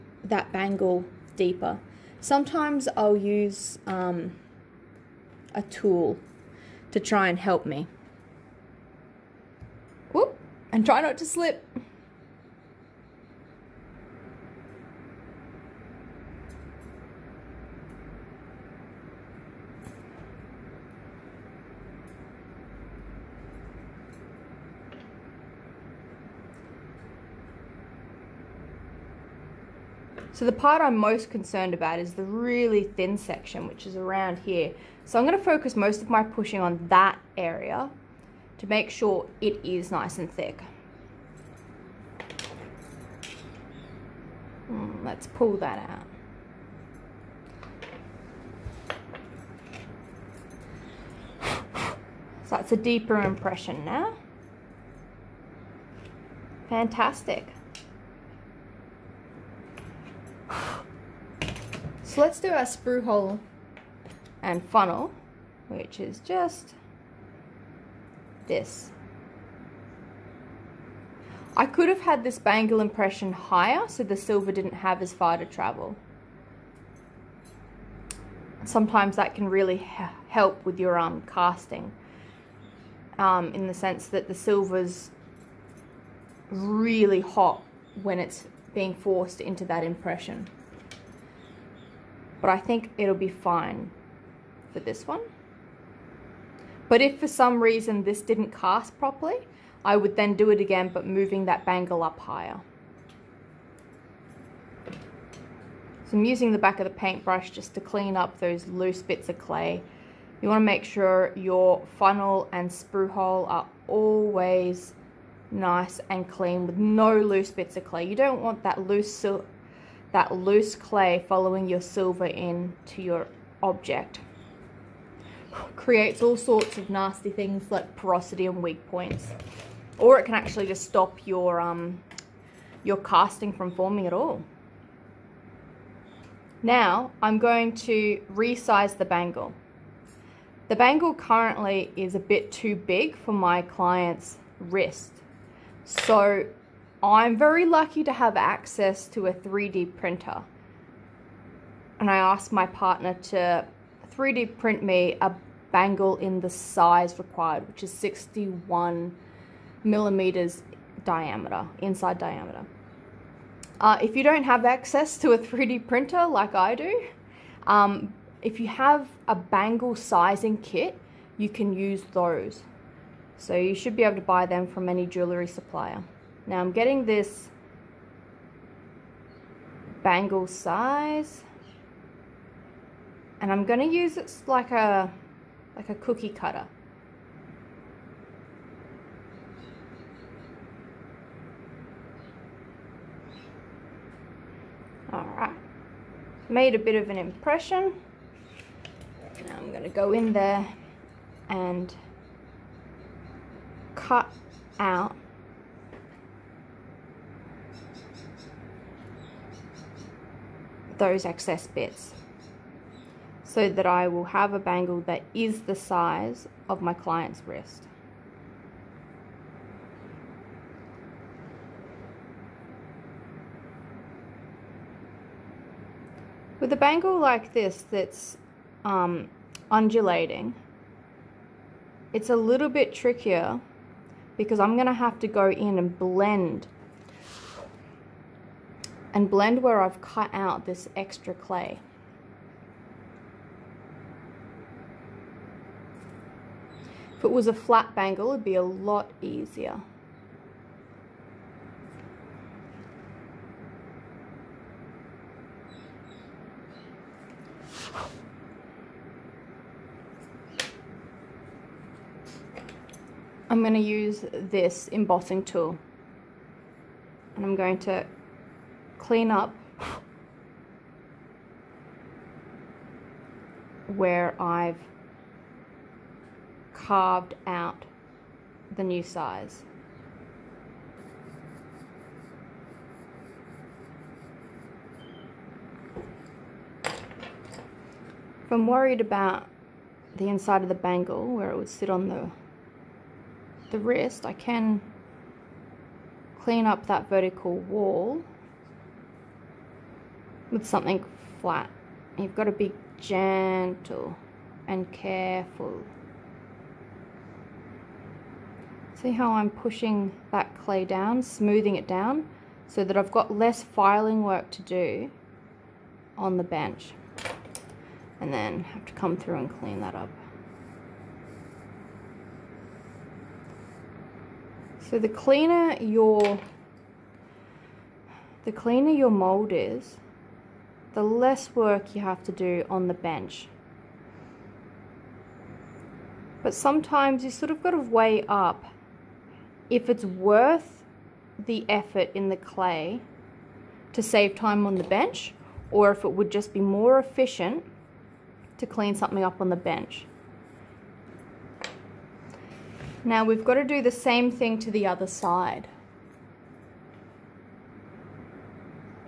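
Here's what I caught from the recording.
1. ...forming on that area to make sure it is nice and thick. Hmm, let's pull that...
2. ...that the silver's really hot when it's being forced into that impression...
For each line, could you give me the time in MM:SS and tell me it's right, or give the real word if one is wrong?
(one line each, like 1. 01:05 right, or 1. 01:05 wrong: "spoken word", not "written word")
1. 00:36 wrong: "pushing", not "forming"
2. 01:24 right.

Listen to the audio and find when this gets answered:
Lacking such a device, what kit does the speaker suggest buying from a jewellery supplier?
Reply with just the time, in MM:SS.
02:49.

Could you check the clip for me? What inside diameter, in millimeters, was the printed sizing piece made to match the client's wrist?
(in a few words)
61.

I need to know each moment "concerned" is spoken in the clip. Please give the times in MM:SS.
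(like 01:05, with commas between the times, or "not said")
00:31.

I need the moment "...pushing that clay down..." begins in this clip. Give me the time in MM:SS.
05:09.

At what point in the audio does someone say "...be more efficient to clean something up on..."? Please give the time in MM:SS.
05:46.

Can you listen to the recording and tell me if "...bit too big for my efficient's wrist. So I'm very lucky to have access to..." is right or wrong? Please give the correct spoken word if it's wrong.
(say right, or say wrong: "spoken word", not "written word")
wrong: "client", not "efficient".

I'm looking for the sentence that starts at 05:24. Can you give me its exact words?
So the cleaner your the cleaner your mold is, the less work you have to do on the bench.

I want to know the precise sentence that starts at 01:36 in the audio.
But if for some reason this didn't cast properly, I would then do it again, but moving that bangle up higher.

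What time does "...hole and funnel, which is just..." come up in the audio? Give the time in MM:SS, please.
01:03.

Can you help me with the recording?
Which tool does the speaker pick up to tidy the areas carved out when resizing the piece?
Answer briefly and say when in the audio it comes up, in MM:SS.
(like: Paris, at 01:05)
embossing tool, at 04:24.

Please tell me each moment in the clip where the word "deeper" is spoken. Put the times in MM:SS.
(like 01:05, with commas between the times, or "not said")
00:01, 00:52.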